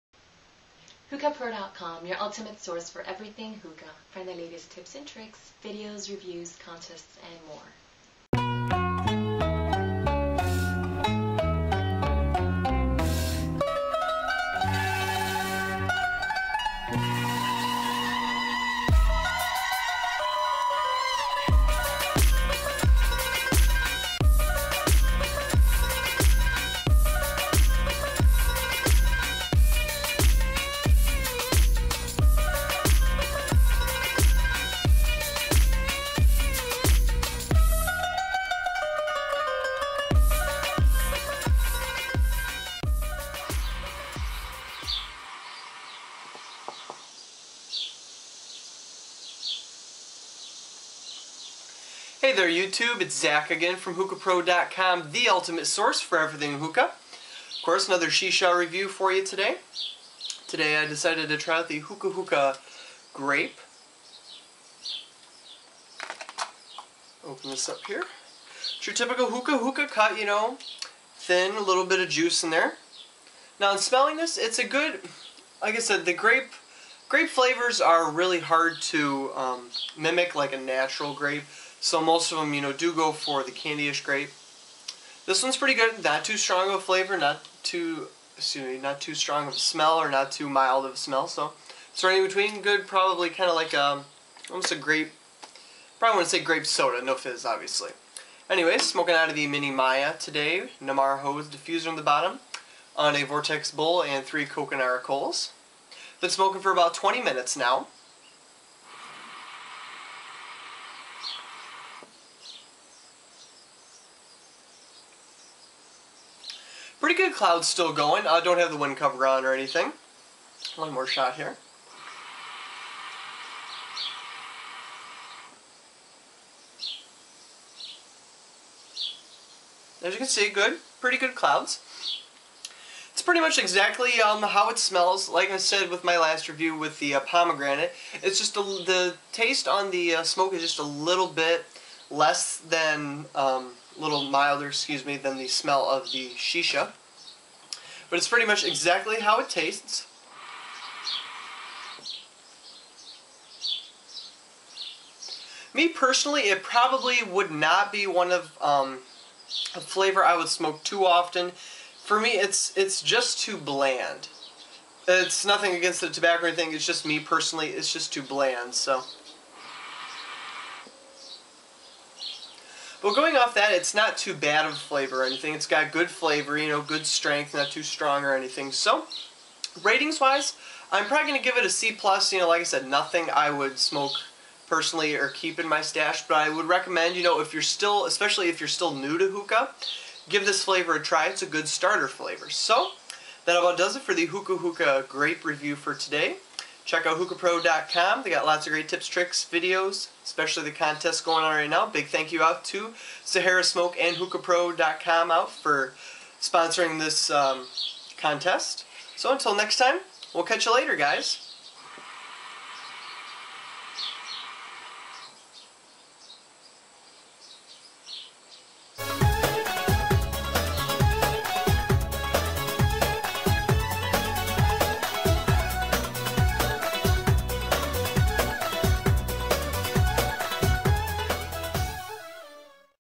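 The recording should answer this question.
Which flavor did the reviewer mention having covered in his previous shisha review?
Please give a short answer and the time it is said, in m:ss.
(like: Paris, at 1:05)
Pomegranate, at 2:17.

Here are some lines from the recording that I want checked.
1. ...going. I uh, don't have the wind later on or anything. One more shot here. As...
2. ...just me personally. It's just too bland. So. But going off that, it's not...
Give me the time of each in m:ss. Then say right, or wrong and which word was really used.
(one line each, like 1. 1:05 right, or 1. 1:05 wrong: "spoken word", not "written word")
1. 1:57 wrong: "cover", not "later"
2. 2:46 right.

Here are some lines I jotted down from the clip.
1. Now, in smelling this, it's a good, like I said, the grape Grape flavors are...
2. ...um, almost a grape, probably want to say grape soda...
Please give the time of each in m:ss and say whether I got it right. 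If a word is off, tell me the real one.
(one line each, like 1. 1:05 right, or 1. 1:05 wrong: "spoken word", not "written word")
1. 1:13 right
2. 1:33 right.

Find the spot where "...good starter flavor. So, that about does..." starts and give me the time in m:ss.
3:11.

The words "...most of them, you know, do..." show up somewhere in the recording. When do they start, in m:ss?
1:21.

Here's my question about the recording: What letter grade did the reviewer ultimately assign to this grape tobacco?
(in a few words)
C+.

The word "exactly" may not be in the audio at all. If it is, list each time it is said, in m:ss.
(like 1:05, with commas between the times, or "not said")
2:13, 2:28.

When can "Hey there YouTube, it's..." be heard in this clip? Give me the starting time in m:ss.
0:52.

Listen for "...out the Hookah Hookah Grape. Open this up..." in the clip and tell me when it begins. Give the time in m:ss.
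1:01.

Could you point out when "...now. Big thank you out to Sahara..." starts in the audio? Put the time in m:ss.
3:21.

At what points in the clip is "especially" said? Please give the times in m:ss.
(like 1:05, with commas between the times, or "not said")
3:08, 3:20.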